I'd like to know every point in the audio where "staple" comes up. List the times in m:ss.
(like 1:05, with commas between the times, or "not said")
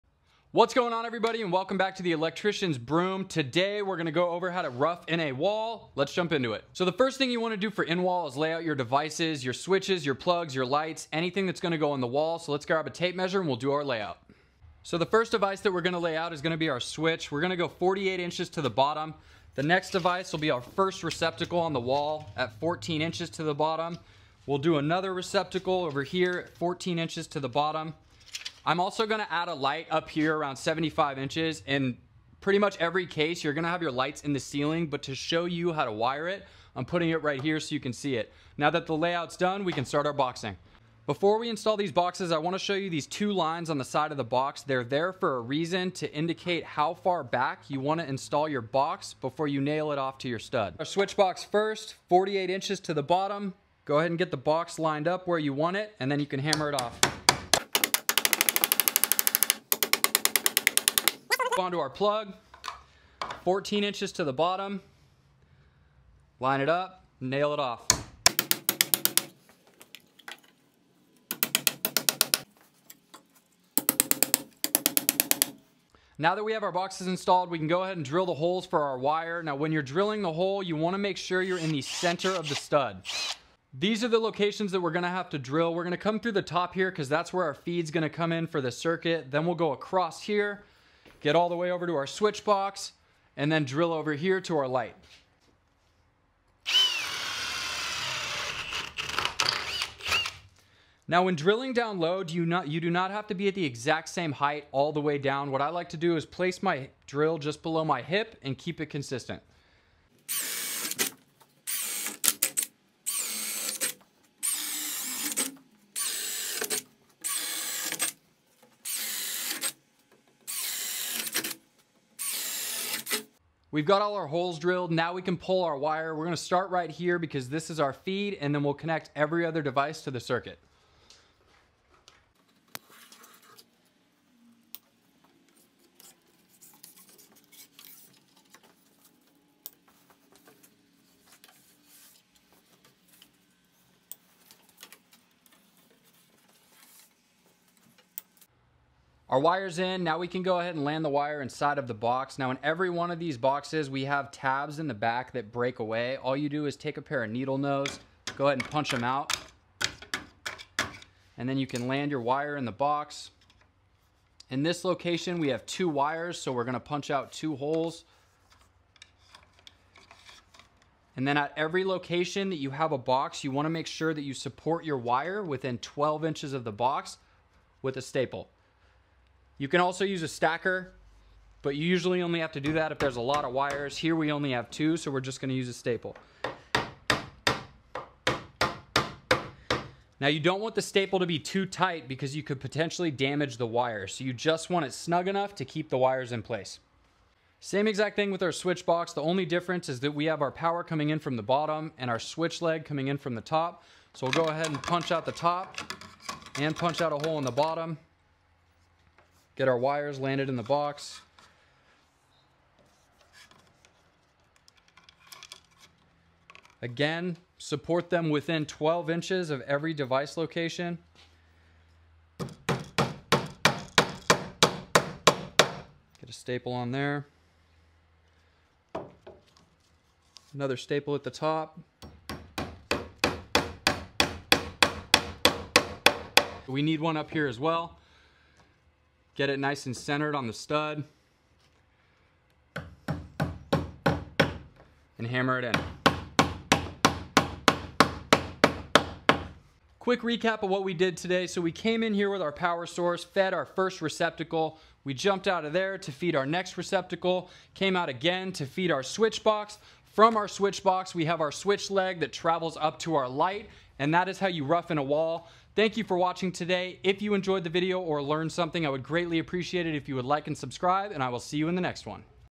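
2:58, 3:05, 3:10, 3:46, 3:50.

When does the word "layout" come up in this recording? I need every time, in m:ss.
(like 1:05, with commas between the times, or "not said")
0:13, 0:38.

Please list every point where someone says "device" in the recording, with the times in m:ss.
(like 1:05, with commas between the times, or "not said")
0:08, 0:15, 0:19, 2:09, 3:39.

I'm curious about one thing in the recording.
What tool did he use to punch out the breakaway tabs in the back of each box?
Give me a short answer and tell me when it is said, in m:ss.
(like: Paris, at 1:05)
needle nose, at 2:37.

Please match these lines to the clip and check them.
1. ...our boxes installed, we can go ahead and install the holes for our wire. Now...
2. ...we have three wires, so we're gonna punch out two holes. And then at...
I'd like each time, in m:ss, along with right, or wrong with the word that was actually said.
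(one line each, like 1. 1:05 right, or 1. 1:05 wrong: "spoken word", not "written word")
1. 1:16 wrong: "drill", not "install"
2. 2:45 wrong: "two", not "three".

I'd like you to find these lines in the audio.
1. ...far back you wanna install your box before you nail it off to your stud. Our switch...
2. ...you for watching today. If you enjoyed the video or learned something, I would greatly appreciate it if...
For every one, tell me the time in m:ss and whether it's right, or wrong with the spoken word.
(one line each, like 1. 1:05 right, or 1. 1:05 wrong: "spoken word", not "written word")
1. 0:46 right
2. 4:25 right.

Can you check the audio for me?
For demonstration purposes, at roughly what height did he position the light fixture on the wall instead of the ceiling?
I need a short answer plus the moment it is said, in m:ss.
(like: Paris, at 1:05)
75 inches, at 0:30.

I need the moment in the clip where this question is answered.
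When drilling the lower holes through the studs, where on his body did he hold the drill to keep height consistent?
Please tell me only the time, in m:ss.
1:47.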